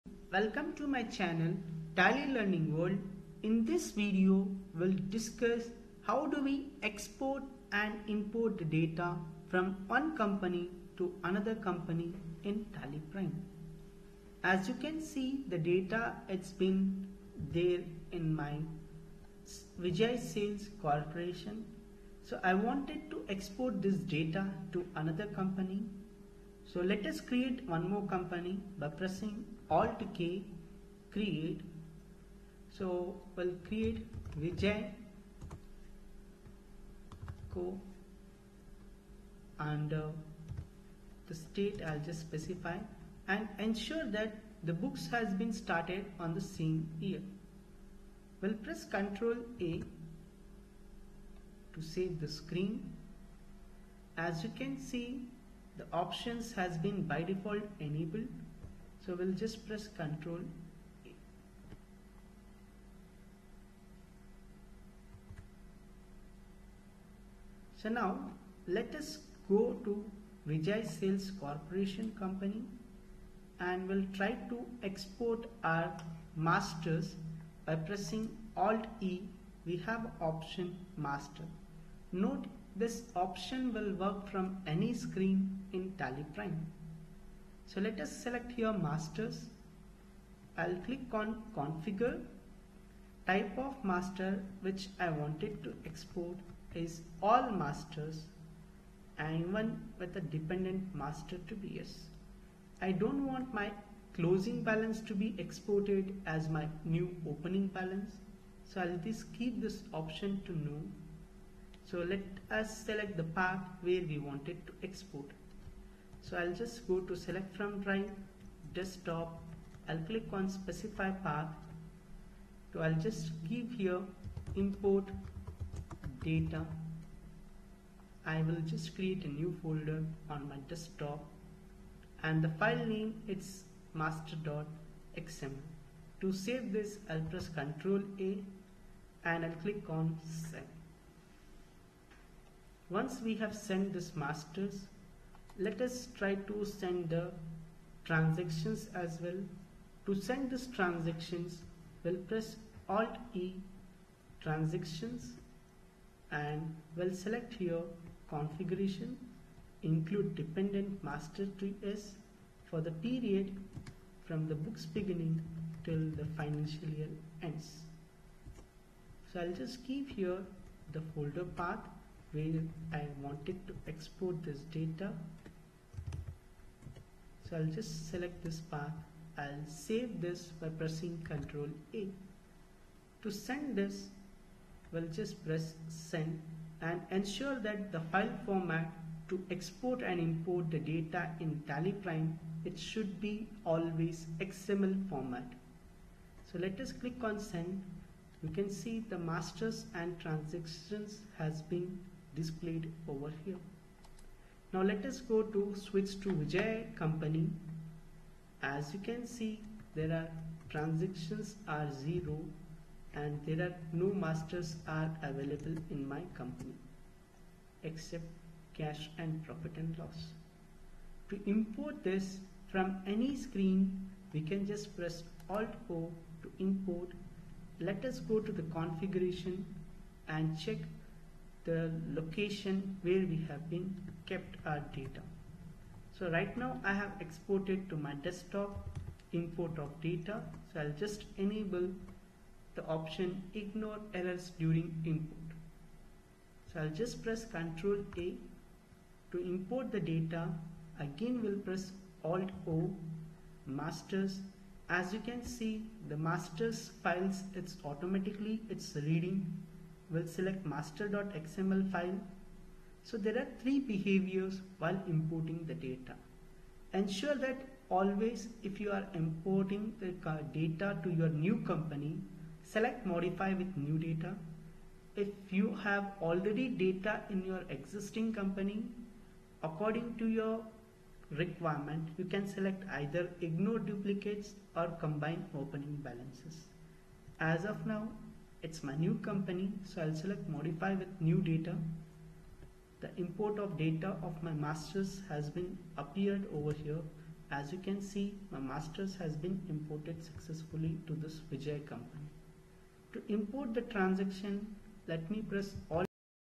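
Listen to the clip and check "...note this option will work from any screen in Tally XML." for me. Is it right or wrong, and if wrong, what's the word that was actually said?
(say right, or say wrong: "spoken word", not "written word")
wrong: "Prime", not "XML".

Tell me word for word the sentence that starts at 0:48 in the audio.
We'll press Ctrl A to save the screen.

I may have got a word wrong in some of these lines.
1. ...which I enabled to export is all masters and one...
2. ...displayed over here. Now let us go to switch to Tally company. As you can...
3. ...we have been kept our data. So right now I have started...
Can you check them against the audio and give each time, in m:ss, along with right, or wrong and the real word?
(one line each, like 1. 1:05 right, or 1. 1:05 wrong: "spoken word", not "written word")
1. 1:34 wrong: "wanted", not "enabled"
2. 3:22 wrong: "Vijay", not "Tally"
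3. 3:53 wrong: "exported", not "started".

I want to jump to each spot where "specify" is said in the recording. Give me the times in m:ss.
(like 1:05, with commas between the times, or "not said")
0:42, 2:00.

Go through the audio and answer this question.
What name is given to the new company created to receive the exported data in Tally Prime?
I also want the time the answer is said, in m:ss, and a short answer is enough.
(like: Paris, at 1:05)
Vijay Co, at 0:34.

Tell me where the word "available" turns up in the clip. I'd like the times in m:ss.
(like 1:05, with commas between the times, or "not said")
3:35.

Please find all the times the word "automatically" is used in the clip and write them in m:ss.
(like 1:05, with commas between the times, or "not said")
4:17.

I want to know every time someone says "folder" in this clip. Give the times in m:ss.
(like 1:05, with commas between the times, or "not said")
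2:09, 2:51.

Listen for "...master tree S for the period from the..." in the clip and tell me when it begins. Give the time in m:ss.
2:41.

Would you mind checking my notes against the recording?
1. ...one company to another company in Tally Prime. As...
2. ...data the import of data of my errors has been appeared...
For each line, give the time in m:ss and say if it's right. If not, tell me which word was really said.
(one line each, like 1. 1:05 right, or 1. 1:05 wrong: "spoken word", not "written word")
1. 0:09 right
2. 4:51 wrong: "masters", not "errors".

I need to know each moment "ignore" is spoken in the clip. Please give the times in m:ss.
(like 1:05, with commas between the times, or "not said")
4:03, 4:43.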